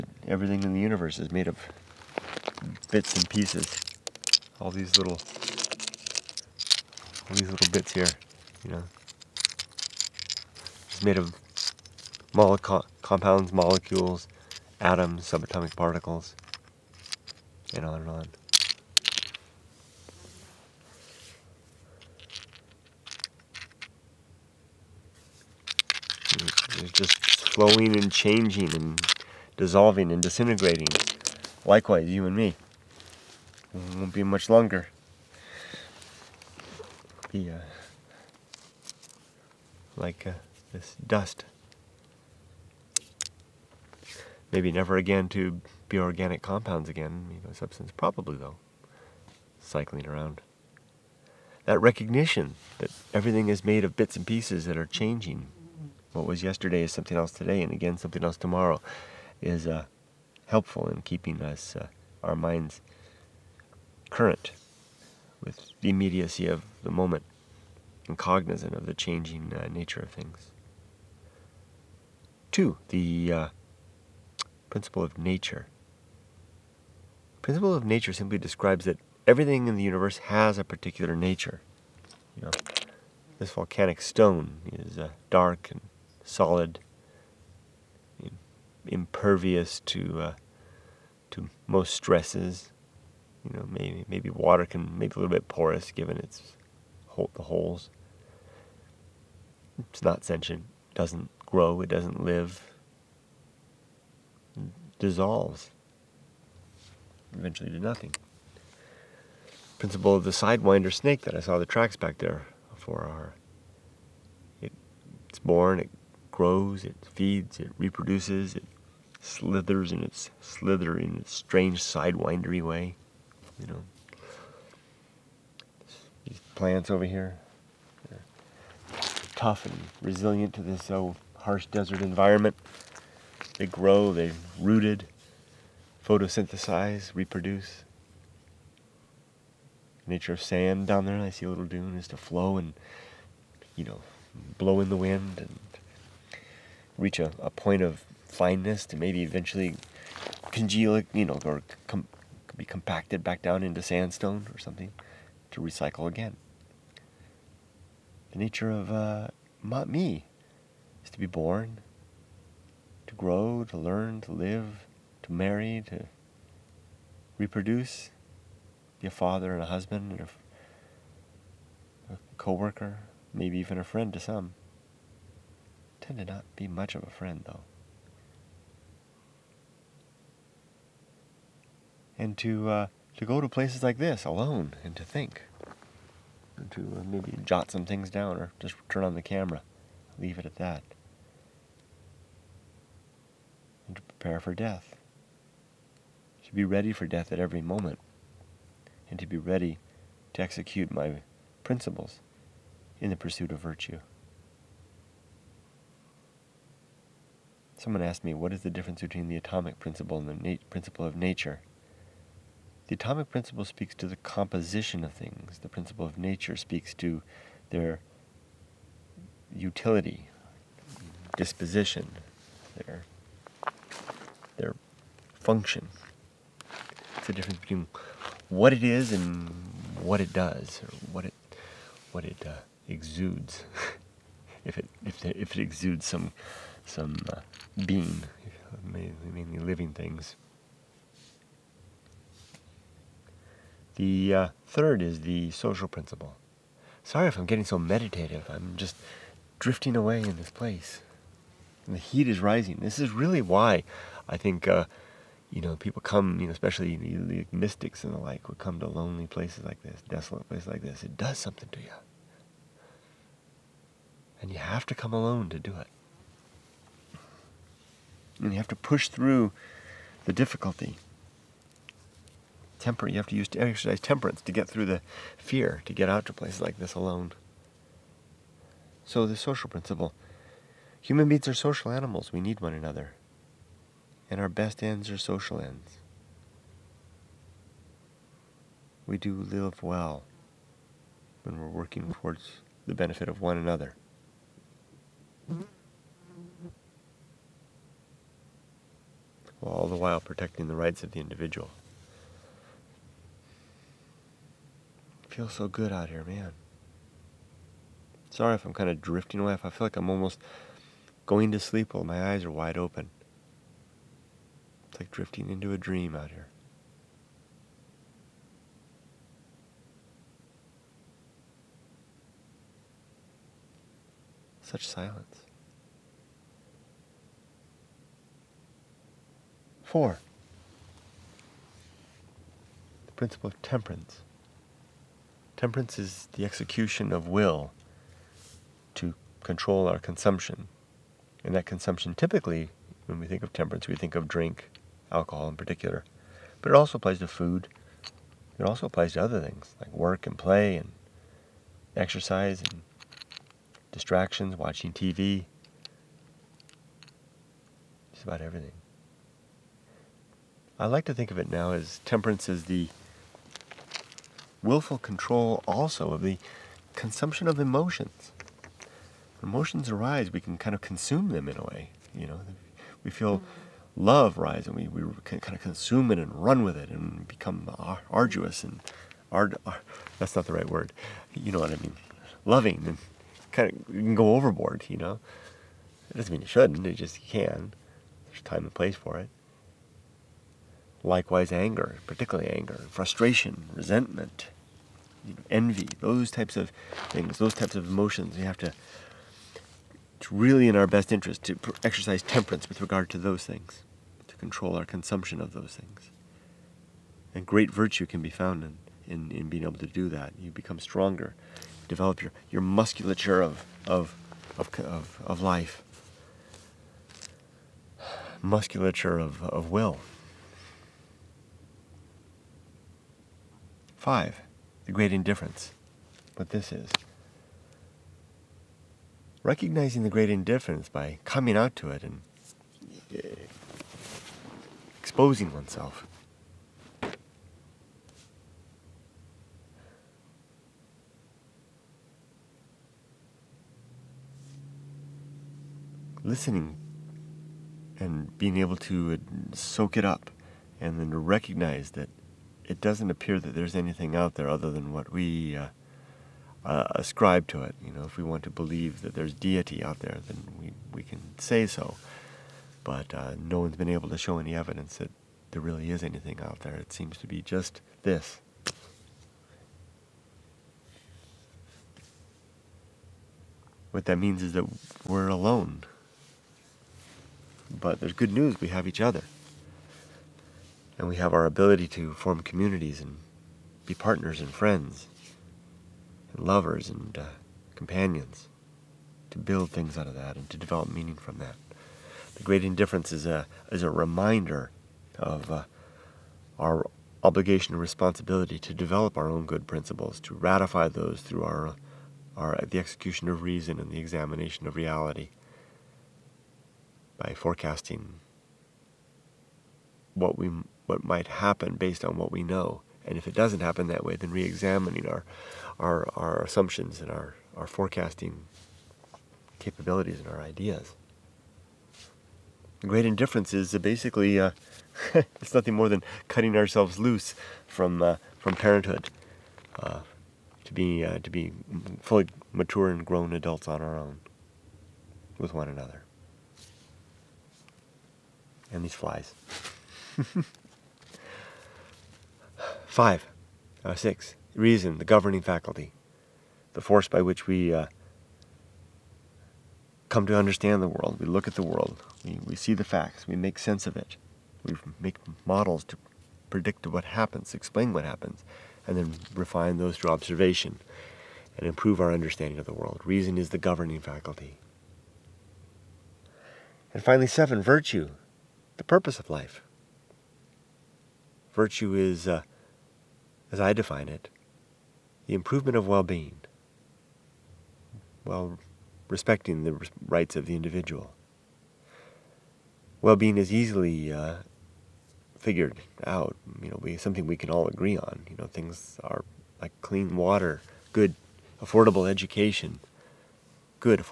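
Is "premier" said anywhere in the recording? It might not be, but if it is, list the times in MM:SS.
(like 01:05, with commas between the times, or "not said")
not said.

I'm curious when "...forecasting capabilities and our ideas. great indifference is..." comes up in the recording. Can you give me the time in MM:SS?
08:37.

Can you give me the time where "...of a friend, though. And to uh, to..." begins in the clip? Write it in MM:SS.
02:56.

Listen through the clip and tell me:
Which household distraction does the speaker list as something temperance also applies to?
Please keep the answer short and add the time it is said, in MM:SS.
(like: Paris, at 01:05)
watching TV, at 05:54.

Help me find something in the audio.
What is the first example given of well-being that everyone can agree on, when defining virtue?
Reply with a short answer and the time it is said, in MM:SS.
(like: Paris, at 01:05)
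clean water, at 09:49.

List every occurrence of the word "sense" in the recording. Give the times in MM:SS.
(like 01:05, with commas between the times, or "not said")
09:13.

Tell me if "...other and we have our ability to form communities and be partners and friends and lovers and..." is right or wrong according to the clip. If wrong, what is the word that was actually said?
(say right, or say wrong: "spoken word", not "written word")
right.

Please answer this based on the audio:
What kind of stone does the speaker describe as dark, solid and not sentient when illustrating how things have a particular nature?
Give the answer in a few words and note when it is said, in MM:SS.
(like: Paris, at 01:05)
volcanic stone, at 01:23.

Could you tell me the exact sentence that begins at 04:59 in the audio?
while all the while protecting the rights of the individual.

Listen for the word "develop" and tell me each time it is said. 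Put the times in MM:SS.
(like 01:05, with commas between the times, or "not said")
06:51, 08:10, 08:18.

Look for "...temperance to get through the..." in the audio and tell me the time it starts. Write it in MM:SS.
04:34.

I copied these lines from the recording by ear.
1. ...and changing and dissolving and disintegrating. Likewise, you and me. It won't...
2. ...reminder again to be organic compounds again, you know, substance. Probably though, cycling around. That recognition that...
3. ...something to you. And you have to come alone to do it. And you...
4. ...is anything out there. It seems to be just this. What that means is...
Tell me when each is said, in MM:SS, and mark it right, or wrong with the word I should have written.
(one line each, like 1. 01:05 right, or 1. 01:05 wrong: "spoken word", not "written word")
1. 00:27 right
2. 00:44 wrong: "never", not "reminder"
3. 04:21 right
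4. 07:45 right.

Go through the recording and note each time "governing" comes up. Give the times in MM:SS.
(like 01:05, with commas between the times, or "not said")
09:05, 09:23.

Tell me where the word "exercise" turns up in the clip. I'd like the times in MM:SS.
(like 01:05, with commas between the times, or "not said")
04:33, 05:51, 06:41.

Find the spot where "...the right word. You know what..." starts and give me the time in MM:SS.
06:20.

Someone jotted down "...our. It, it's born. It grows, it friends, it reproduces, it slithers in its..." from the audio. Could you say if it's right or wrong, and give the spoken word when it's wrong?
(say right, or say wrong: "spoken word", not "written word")
wrong: "feeds", not "friends".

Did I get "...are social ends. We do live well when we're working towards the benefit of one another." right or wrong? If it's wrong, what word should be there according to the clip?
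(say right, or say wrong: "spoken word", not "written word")
right.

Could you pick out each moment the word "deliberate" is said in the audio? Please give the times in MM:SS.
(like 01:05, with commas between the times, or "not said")
not said.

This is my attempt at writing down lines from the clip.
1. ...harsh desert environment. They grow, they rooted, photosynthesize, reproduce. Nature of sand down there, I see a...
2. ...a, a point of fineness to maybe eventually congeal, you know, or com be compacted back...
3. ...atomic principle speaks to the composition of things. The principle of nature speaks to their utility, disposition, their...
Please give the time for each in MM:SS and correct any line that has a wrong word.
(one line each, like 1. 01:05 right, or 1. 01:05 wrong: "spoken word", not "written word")
1. 02:11 right
2. 02:27 right
3. 03:32 right.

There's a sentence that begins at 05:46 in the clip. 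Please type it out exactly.
But it also applies to food.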